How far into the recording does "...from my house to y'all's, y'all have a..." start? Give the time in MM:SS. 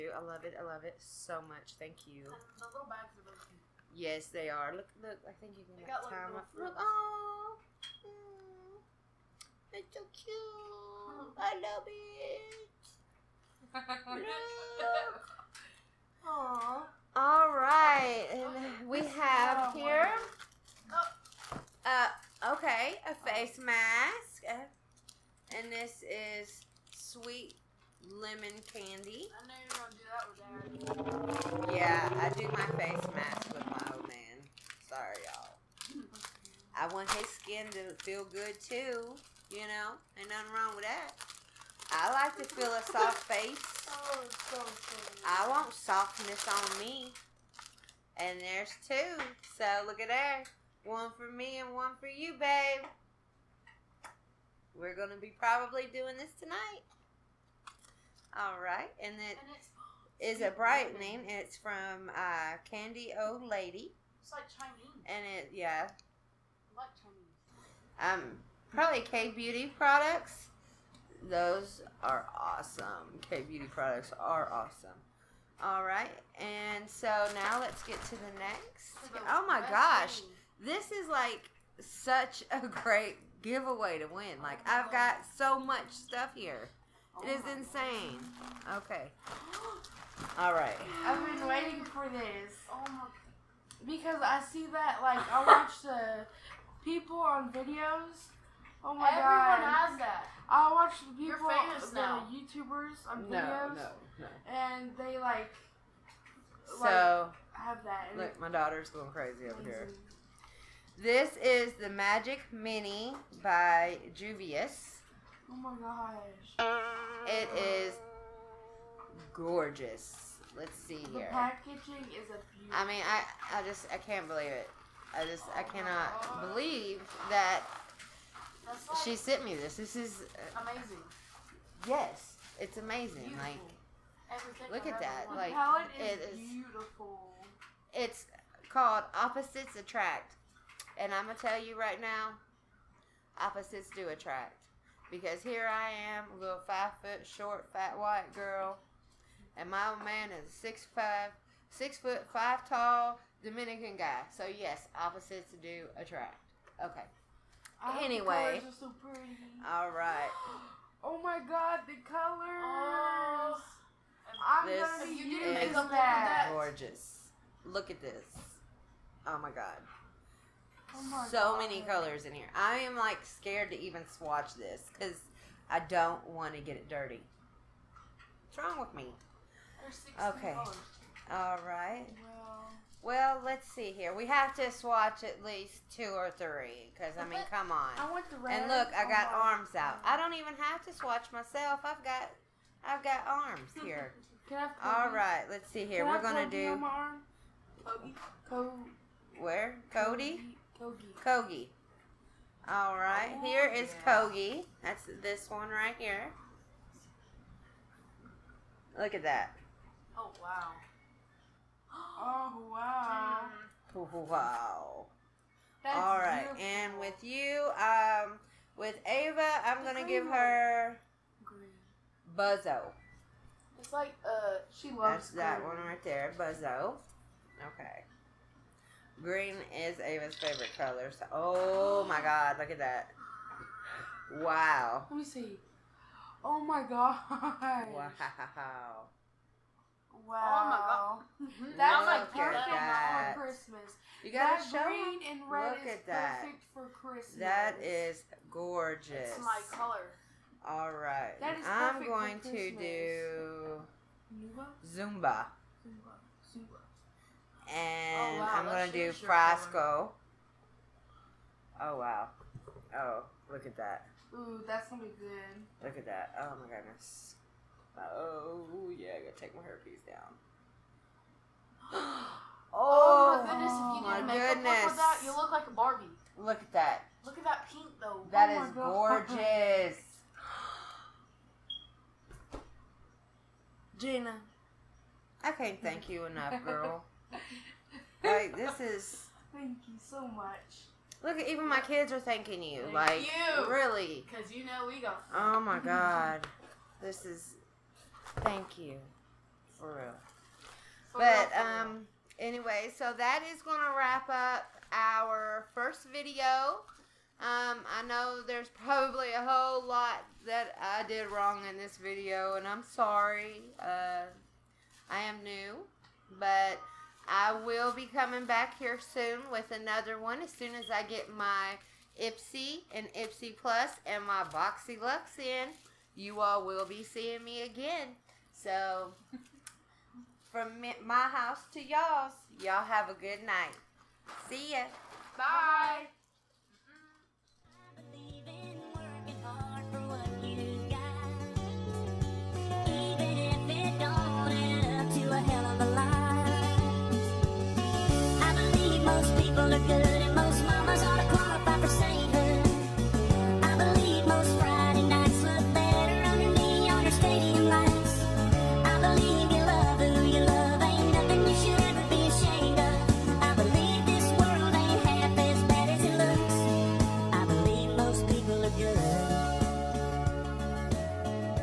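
05:30.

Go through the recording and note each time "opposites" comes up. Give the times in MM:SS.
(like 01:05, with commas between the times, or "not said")
02:19, 02:23, 02:35.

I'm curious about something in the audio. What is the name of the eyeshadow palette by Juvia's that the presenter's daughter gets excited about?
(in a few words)
Magic Mini.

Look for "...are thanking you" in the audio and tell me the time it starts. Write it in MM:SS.
04:52.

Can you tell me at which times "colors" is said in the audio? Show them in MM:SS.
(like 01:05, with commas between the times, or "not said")
02:42, 02:51, 03:00, 03:50, 04:09.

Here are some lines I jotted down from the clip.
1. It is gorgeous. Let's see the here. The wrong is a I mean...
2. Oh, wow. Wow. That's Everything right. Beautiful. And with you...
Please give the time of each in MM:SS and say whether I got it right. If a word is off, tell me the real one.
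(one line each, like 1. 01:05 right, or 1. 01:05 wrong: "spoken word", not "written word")
1. 01:57 wrong: "packaging", not "wrong"
2. 03:32 wrong: "All", not "Everything".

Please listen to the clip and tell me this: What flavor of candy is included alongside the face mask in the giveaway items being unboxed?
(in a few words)
Sweet lemon.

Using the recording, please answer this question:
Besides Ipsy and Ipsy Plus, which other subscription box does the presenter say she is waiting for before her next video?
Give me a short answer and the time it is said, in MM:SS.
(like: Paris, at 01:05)
Boxy Lux, at 05:24.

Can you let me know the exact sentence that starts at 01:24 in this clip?
Like oh I've got so much stuff here.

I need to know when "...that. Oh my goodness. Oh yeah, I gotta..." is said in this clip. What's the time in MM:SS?
04:26.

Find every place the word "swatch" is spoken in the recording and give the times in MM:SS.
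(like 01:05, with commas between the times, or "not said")
02:54, 03:04, 03:10.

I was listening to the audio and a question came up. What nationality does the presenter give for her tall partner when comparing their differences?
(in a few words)
Dominican.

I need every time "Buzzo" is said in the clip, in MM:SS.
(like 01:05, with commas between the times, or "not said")
03:42, 03:46.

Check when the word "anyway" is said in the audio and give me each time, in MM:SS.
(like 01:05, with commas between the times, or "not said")
02:38, 05:02.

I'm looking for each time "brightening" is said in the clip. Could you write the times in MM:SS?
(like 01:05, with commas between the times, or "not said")
01:00.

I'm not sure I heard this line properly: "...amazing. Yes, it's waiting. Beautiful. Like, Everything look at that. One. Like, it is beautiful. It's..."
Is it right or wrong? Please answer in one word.
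wrong.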